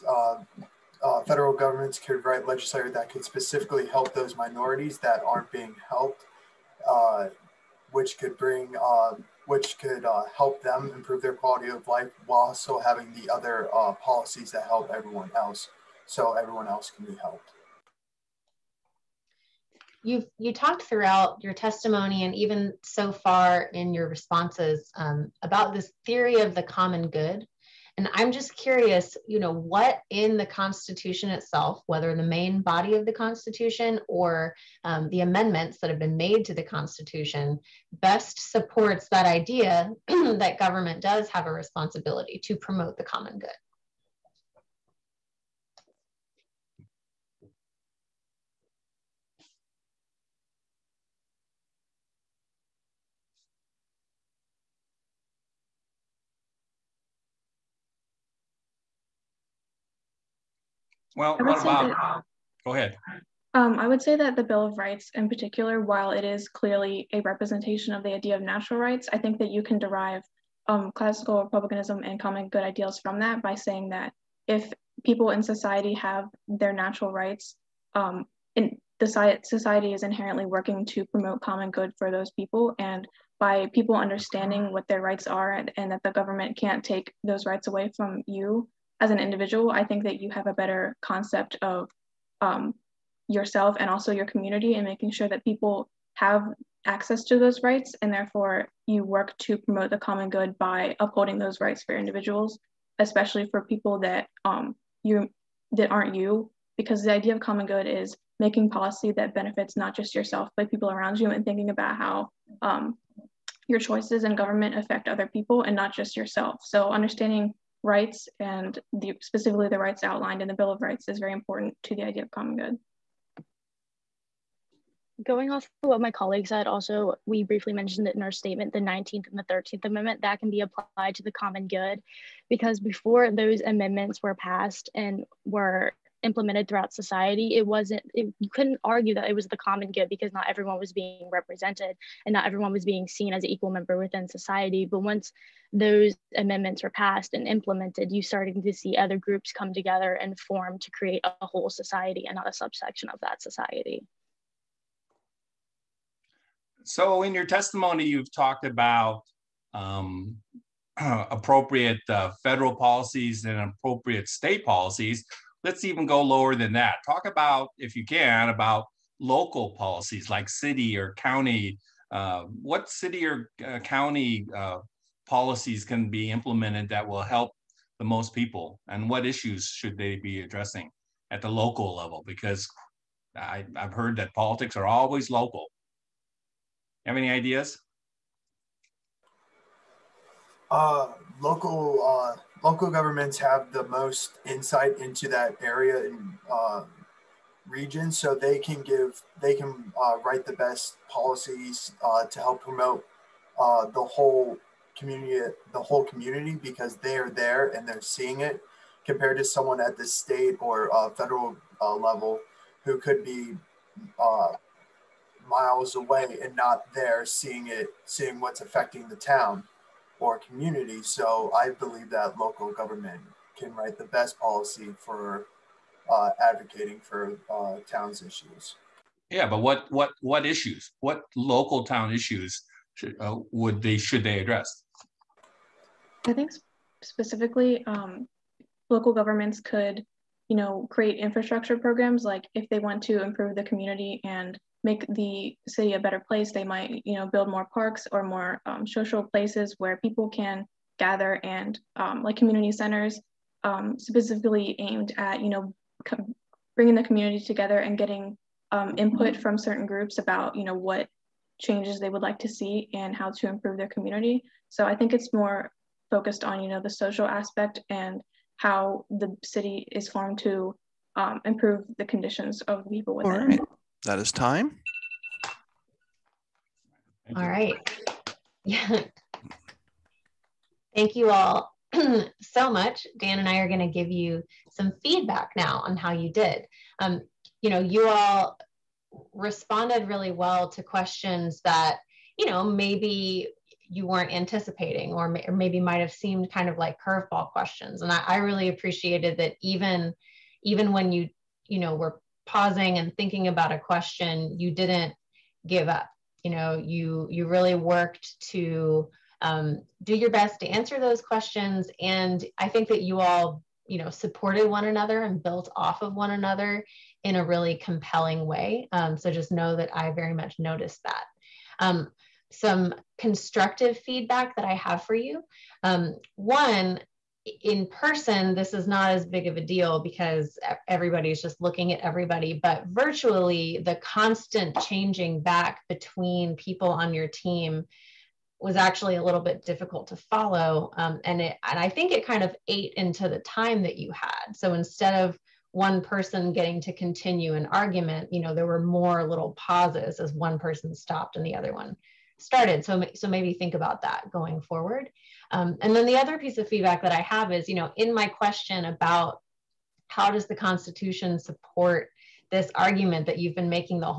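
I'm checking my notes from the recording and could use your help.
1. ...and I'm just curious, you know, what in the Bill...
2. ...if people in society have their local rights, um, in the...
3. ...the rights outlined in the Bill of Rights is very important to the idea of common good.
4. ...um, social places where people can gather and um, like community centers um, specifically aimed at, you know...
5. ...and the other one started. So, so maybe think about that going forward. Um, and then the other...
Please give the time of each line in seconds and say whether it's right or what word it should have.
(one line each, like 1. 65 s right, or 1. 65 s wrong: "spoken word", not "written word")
1. 27 s wrong: "Constitution", not "Bill"
2. 74 s wrong: "natural", not "local"
3. 119 s right
4. 248 s right
5. 351 s right.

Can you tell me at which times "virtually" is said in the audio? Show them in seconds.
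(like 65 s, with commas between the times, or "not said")
332 s.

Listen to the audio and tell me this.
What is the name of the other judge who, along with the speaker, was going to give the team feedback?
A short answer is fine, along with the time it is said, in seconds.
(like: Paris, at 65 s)
Dan, at 283 s.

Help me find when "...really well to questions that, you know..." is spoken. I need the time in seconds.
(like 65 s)
290 s.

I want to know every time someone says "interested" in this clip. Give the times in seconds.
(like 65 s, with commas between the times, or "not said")
not said.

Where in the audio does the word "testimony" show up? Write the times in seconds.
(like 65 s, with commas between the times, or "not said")
21 s, 157 s.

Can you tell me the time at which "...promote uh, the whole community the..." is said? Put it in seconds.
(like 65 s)
202 s.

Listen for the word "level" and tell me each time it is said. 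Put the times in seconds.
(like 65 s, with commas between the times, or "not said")
181 s, 211 s.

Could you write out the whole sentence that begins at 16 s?
So everyone else can be helped.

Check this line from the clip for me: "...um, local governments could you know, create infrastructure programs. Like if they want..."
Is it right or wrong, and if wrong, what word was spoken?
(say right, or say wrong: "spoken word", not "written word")
right.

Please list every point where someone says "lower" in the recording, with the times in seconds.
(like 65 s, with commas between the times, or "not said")
166 s.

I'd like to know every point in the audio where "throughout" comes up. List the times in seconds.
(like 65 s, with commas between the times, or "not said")
20 s, 136 s.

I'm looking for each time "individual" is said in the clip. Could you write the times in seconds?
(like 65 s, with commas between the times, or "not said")
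89 s, 101 s.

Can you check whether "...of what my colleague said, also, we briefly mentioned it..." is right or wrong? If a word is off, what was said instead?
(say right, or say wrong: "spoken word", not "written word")
right.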